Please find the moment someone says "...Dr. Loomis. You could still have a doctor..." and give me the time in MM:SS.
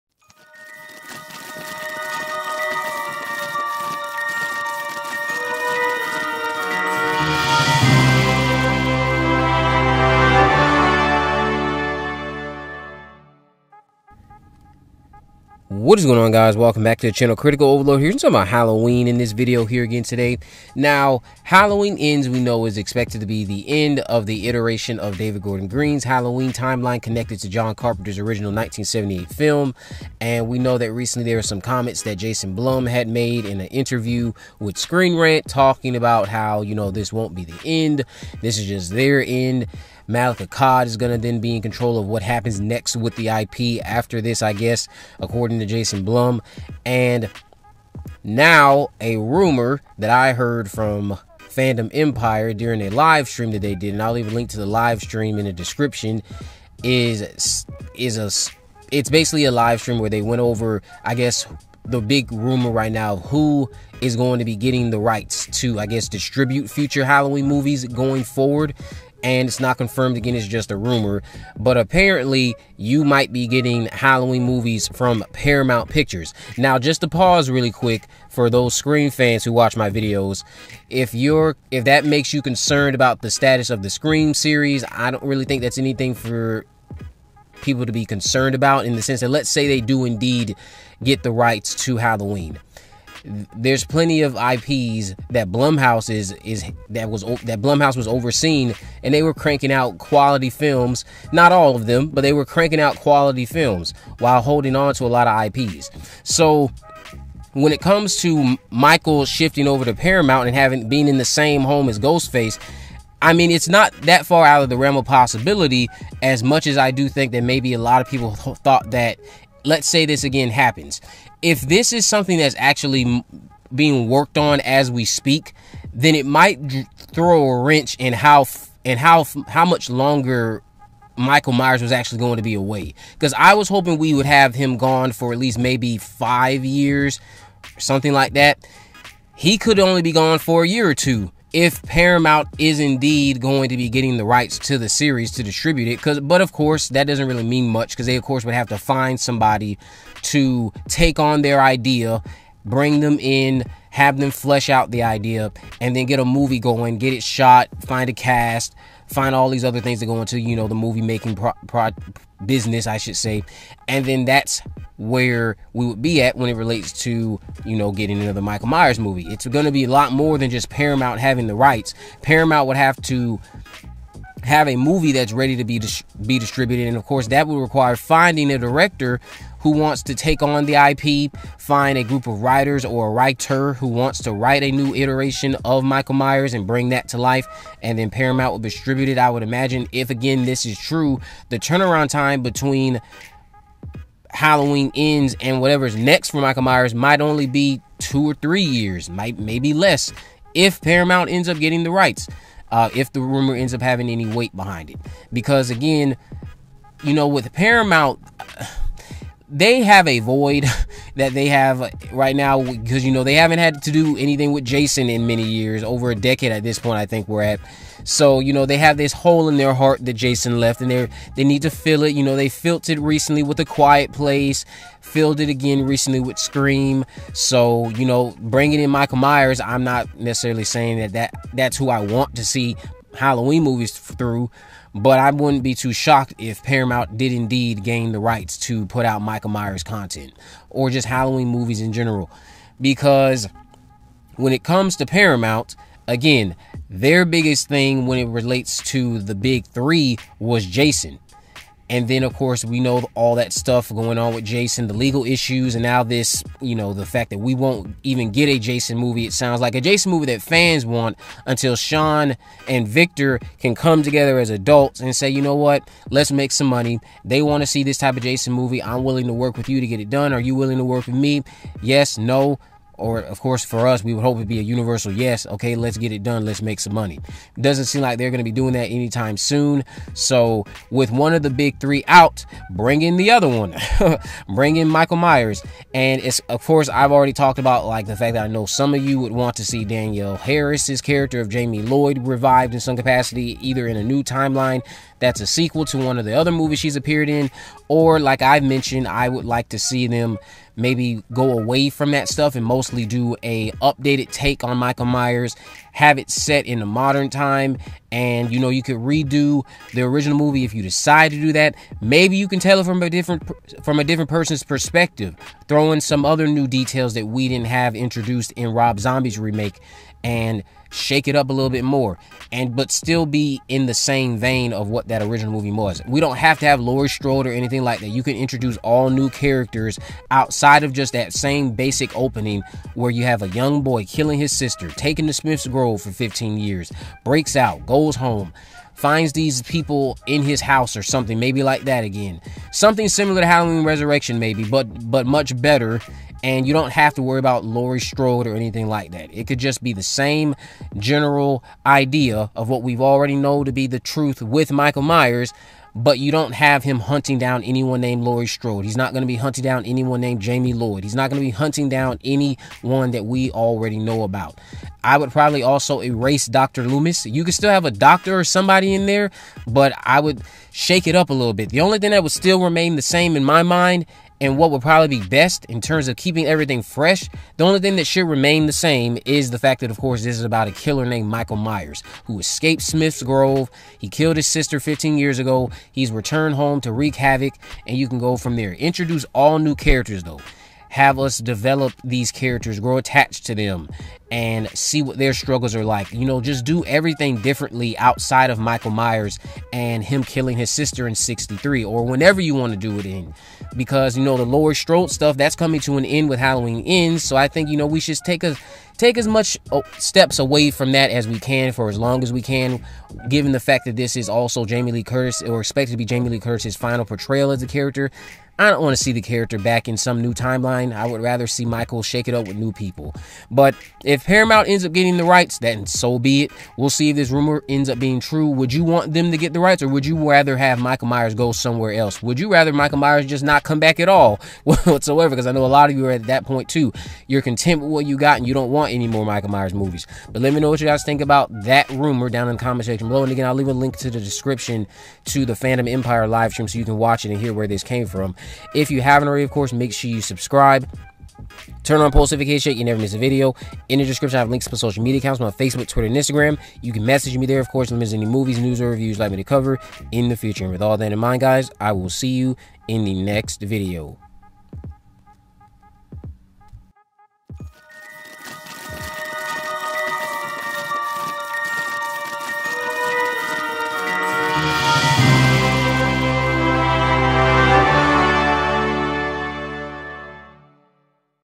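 06:06.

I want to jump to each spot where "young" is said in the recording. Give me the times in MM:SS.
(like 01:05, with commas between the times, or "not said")
05:33.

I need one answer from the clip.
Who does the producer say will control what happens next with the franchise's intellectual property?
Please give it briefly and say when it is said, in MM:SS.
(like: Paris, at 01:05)
Malek Akkad, at 00:40.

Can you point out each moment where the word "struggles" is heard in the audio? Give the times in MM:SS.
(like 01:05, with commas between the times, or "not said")
06:35.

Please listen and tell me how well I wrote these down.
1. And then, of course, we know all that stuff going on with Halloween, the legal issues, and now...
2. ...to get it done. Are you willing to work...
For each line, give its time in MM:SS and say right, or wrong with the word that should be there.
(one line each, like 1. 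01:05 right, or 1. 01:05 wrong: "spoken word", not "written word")
1. 04:11 wrong: "Jason", not "Halloween"
2. 04:29 right.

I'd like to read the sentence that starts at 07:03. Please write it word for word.
But if Paramount ends up getting the rights, then so be it.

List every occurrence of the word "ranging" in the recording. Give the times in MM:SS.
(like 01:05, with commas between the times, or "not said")
not said.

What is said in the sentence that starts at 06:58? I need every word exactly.
I don't want to see the character back in some new timeline.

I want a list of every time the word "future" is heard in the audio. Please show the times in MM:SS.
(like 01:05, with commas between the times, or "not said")
01:06, 07:40.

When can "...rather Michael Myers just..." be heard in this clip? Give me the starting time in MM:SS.
07:12.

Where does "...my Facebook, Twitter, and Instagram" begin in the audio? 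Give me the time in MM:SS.
07:35.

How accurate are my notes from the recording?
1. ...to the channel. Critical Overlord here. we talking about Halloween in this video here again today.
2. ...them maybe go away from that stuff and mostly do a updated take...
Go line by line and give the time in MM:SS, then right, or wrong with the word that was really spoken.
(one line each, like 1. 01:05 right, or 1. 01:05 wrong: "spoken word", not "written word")
1. 00:16 right
2. 05:00 right.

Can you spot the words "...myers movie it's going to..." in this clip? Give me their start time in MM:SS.
02:48.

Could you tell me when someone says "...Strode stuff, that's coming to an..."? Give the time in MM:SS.
06:44.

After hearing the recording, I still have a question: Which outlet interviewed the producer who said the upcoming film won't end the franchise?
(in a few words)
Screen Rant.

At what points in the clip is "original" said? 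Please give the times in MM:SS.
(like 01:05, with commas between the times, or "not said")
00:28, 05:10, 05:25.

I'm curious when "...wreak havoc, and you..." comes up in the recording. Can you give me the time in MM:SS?
06:26.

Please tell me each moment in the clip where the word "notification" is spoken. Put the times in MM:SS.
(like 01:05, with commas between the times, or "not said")
07:32.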